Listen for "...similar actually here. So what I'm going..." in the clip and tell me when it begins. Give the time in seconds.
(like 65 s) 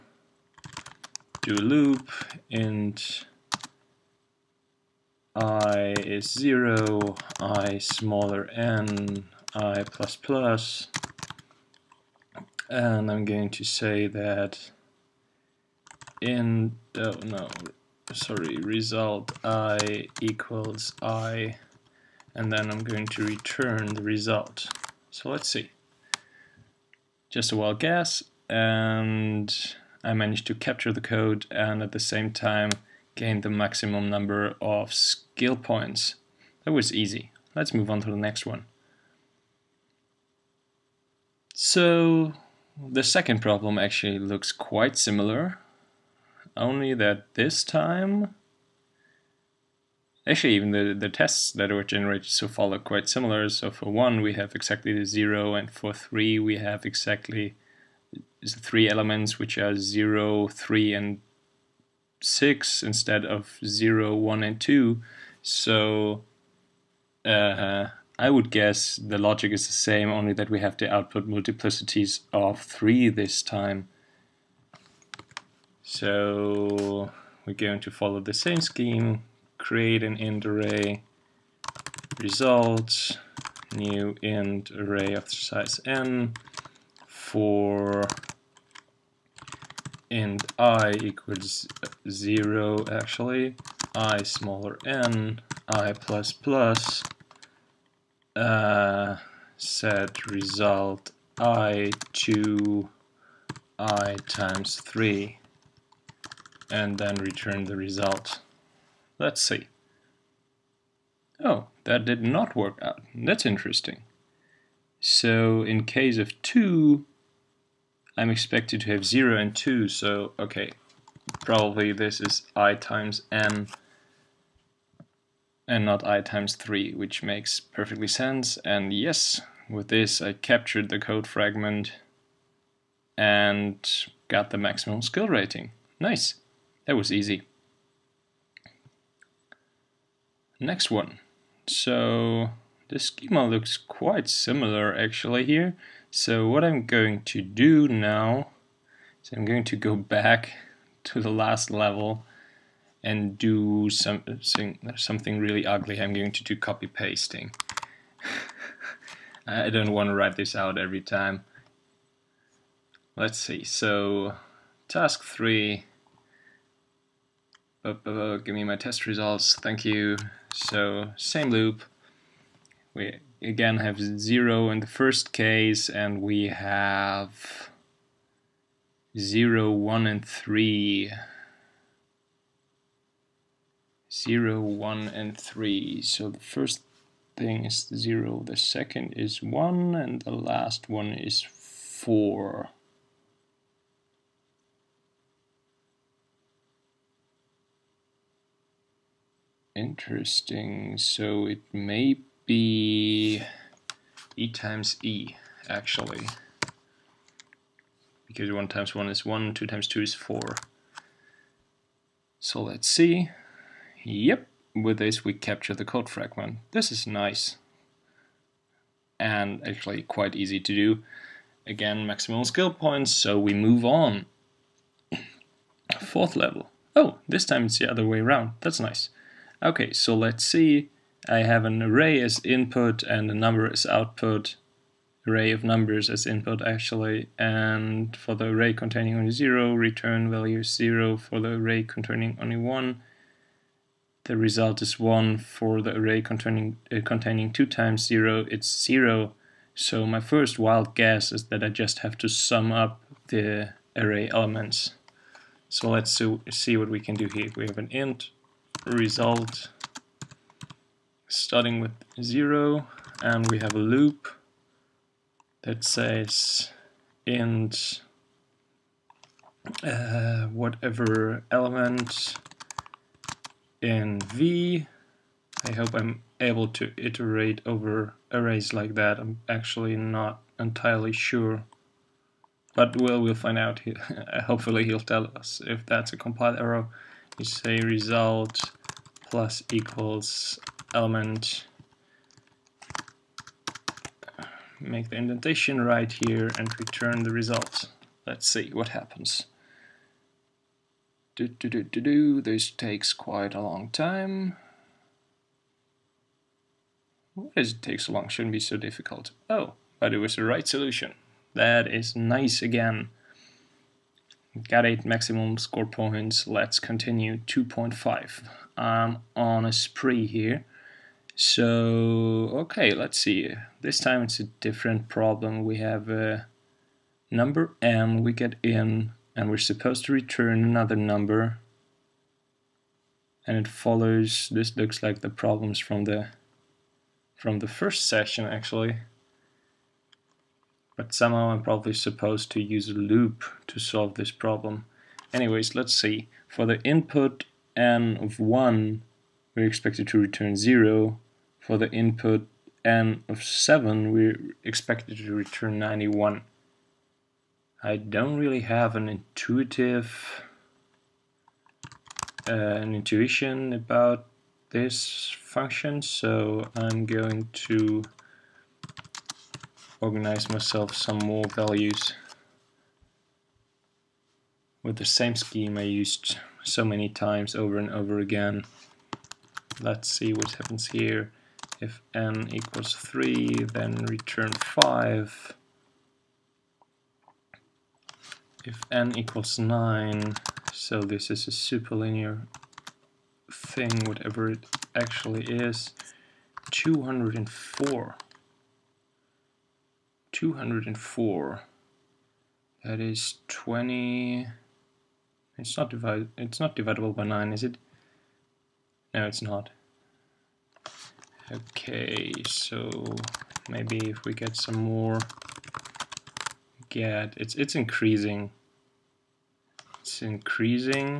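144 s.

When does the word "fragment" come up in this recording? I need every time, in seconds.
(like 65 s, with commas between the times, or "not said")
131 s, 216 s.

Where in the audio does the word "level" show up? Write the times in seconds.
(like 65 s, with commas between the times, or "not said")
151 s, 226 s.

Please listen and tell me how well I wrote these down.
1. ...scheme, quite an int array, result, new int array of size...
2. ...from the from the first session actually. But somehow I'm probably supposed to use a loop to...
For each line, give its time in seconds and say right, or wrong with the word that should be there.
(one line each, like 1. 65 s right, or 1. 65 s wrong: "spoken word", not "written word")
1. 78 s wrong: "create", not "quite"
2. 335 s right.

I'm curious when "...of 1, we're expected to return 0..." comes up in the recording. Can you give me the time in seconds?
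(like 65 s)
348 s.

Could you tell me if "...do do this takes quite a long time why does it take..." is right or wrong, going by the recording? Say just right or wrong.
right.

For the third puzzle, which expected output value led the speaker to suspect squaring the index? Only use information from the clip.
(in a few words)
4.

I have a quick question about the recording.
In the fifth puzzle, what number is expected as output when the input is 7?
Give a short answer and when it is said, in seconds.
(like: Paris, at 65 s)
91, at 355 s.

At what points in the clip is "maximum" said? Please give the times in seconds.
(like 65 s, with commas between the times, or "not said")
33 s, 134 s, 222 s, 315 s.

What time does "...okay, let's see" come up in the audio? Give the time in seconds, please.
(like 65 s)
322 s.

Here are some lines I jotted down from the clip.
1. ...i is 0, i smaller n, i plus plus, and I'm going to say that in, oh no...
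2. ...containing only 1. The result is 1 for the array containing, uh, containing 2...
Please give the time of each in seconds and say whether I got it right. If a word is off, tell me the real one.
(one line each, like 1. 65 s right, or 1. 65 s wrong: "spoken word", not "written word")
1. 5 s right
2. 241 s right.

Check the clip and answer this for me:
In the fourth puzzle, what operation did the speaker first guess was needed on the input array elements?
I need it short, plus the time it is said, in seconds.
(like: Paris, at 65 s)
sum up the array elements, at 252 s.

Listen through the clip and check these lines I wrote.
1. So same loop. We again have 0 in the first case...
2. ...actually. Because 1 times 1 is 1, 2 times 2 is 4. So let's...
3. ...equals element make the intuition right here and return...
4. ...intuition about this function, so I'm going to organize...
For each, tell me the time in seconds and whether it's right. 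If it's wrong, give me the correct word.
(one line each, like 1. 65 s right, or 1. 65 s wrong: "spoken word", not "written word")
1. 170 s right
2. 205 s right
3. 289 s wrong: "indentation", not "intuition"
4. 362 s right.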